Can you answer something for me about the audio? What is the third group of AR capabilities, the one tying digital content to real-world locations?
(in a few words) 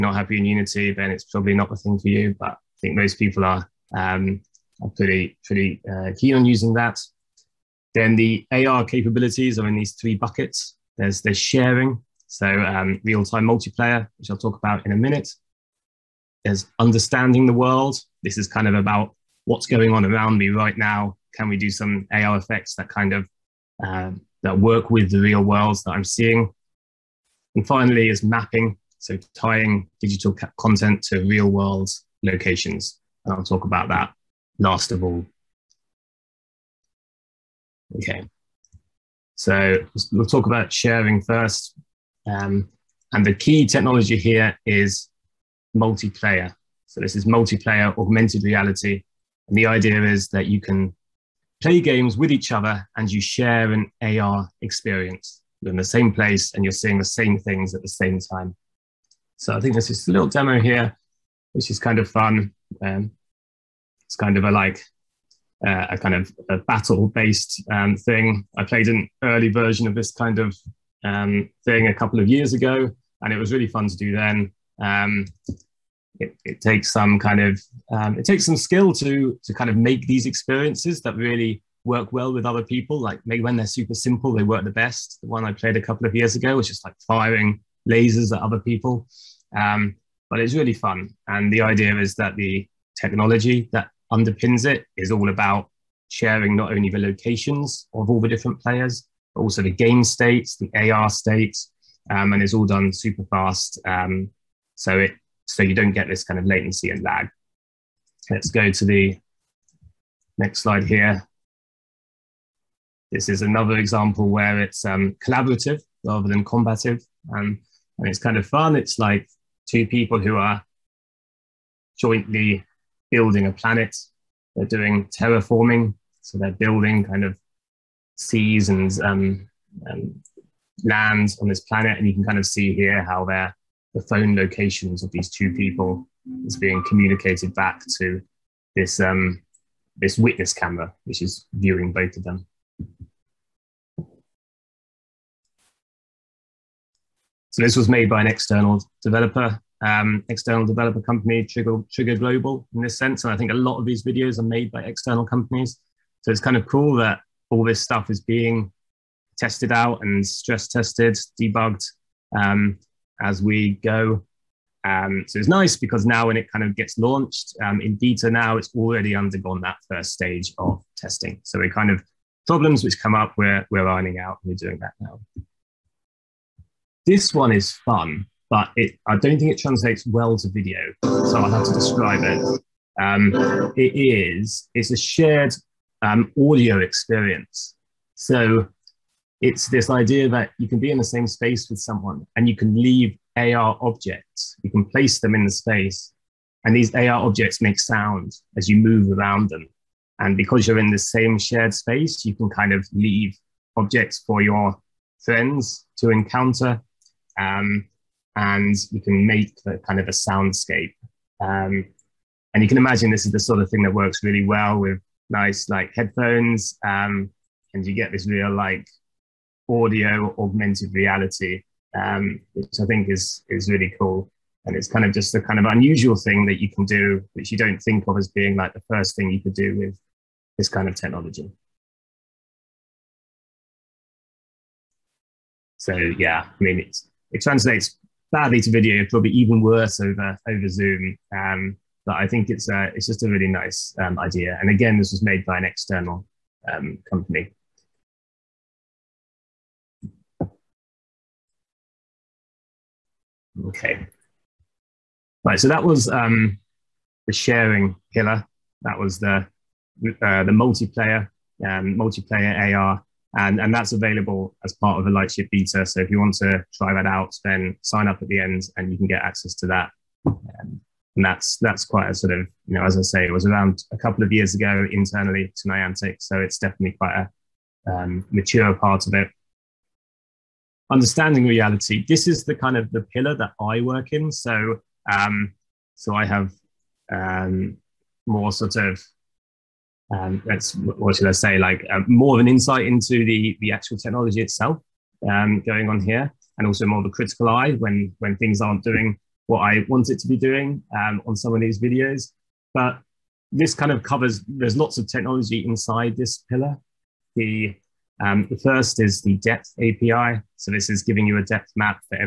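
Mapping.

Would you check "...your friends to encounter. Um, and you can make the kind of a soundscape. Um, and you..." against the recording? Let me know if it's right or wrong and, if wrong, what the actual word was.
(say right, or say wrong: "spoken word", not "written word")
right.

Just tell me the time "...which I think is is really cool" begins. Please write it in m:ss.
3:42.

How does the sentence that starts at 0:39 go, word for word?
So we'll talk about sharing first.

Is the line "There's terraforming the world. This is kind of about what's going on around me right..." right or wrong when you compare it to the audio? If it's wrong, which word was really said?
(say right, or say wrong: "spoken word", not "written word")
wrong: "understanding", not "terraforming".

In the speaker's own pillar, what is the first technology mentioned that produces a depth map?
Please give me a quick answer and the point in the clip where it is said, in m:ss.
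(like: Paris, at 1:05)
The depth API, at 5:09.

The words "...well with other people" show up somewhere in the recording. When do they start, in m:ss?
1:22.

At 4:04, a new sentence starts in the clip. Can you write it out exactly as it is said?
And again, this was made by an external um, company.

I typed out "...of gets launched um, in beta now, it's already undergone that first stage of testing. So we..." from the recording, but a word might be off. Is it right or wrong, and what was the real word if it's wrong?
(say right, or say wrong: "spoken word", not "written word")
right.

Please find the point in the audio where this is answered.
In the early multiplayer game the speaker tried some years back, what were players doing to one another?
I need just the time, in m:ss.
1:27.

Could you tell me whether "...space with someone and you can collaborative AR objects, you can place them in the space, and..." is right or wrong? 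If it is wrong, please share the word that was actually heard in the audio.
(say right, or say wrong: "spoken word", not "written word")
wrong: "leave", not "collaborative".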